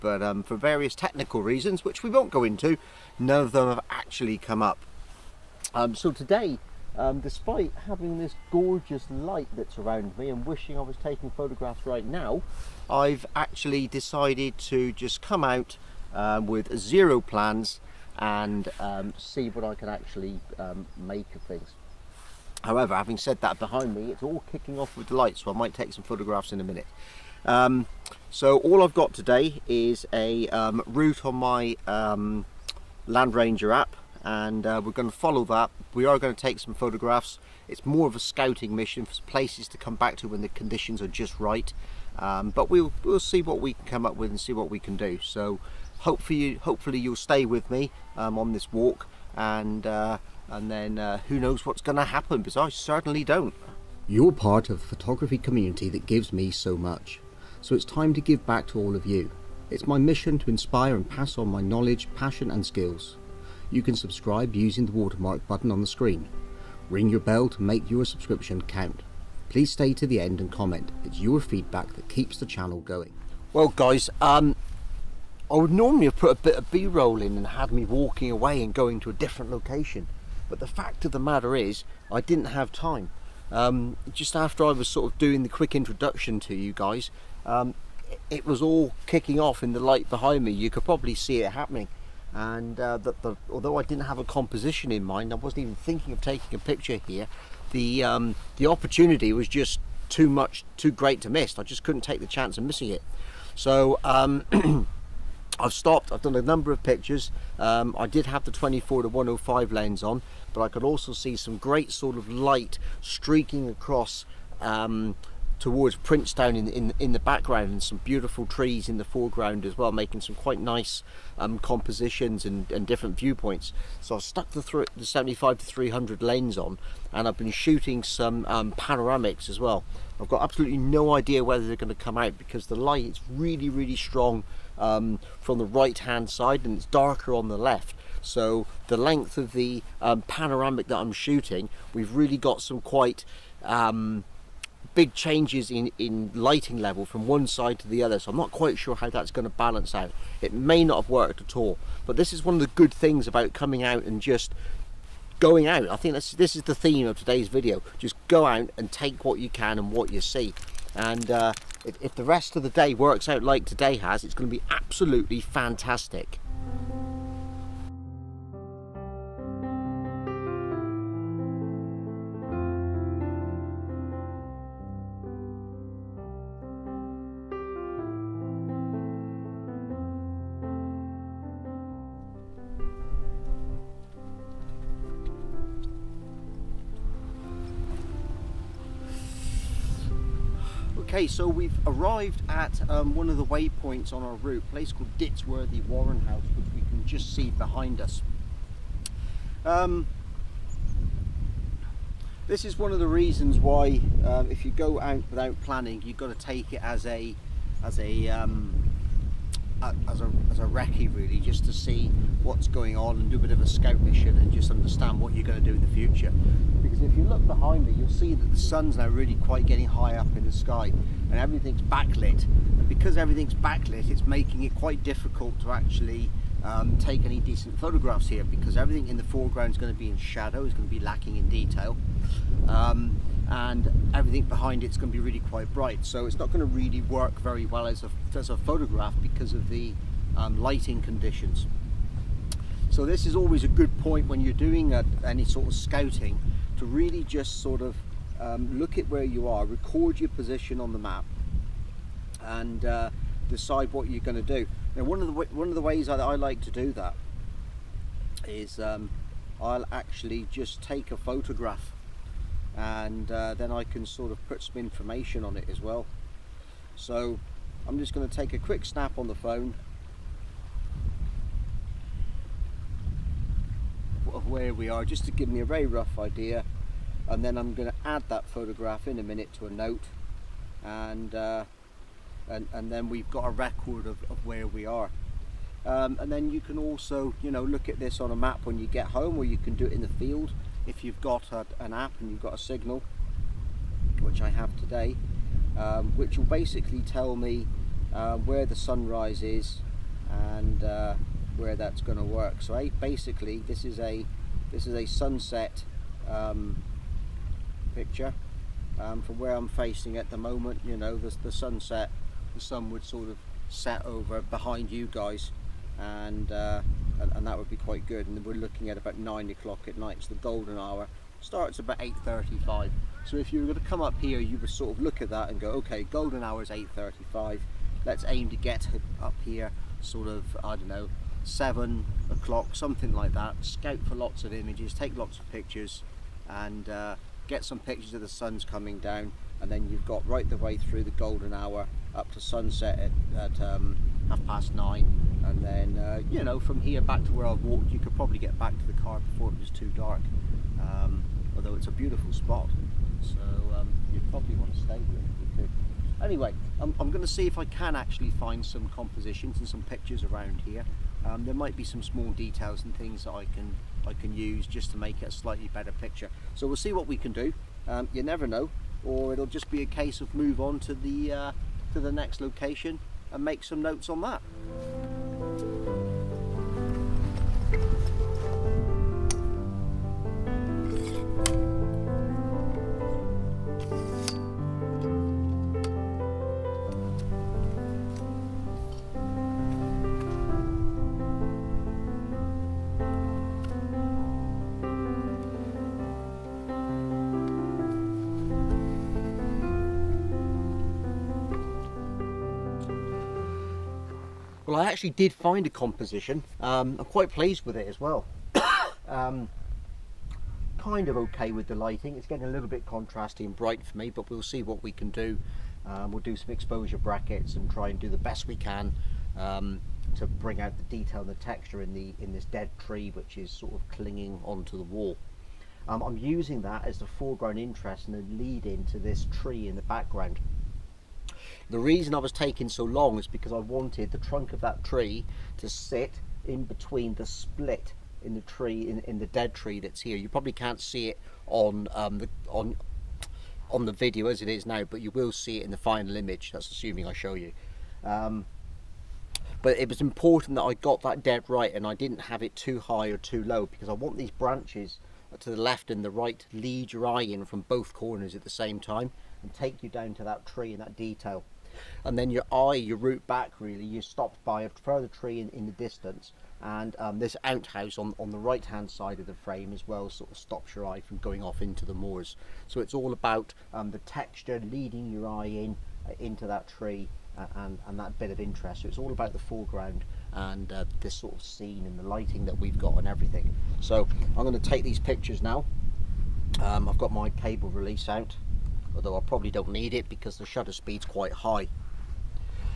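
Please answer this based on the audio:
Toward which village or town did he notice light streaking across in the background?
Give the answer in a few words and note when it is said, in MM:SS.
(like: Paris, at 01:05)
Princetown, at 01:55.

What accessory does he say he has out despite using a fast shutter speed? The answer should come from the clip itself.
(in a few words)
cable release.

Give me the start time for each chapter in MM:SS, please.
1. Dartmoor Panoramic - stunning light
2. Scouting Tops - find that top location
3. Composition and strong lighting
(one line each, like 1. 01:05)
1. 01:12
2. 03:27
3. 06:22.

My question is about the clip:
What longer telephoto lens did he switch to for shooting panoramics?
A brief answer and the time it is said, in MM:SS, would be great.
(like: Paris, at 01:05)
75 to 300, at 02:05.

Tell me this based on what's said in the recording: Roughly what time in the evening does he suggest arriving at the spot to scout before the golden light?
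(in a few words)
7 o'clock.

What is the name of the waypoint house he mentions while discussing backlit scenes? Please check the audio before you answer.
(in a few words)
Ditsworthy Warren House.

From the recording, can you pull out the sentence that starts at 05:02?
So I, basically this is a this is a sunset um, picture um, from where I'm facing at the moment.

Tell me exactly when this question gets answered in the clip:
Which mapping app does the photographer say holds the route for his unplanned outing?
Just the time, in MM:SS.
00:33.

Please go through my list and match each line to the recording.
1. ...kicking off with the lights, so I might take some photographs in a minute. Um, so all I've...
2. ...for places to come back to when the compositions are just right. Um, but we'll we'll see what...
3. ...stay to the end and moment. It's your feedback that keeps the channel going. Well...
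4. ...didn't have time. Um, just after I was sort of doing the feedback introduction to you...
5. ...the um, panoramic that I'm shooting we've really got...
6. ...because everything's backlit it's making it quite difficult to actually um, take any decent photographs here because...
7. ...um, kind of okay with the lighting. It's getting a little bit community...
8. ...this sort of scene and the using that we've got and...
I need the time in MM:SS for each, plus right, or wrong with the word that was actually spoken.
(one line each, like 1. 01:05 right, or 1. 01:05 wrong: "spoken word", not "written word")
1. 00:24 right
2. 00:39 wrong: "conditions", not "compositions"
3. 01:09 wrong: "comment", not "moment"
4. 01:22 wrong: "quick", not "feedback"
5. 02:19 right
6. 03:42 right
7. 06:49 wrong: "contrasty", not "community"
8. 08:00 wrong: "lighting", not "using".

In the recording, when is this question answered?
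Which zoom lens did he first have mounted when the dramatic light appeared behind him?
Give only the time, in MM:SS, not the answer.
01:48.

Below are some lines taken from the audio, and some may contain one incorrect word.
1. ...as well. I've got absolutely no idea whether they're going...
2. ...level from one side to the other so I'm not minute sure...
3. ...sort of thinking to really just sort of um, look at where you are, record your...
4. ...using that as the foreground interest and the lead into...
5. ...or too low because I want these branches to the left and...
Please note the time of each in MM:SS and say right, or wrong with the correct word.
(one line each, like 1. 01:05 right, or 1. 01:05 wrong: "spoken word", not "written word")
1. 02:09 right
2. 02:26 wrong: "quite", not "minute"
3. 04:05 wrong: "scouting", not "thinking"
4. 07:06 right
5. 07:33 right.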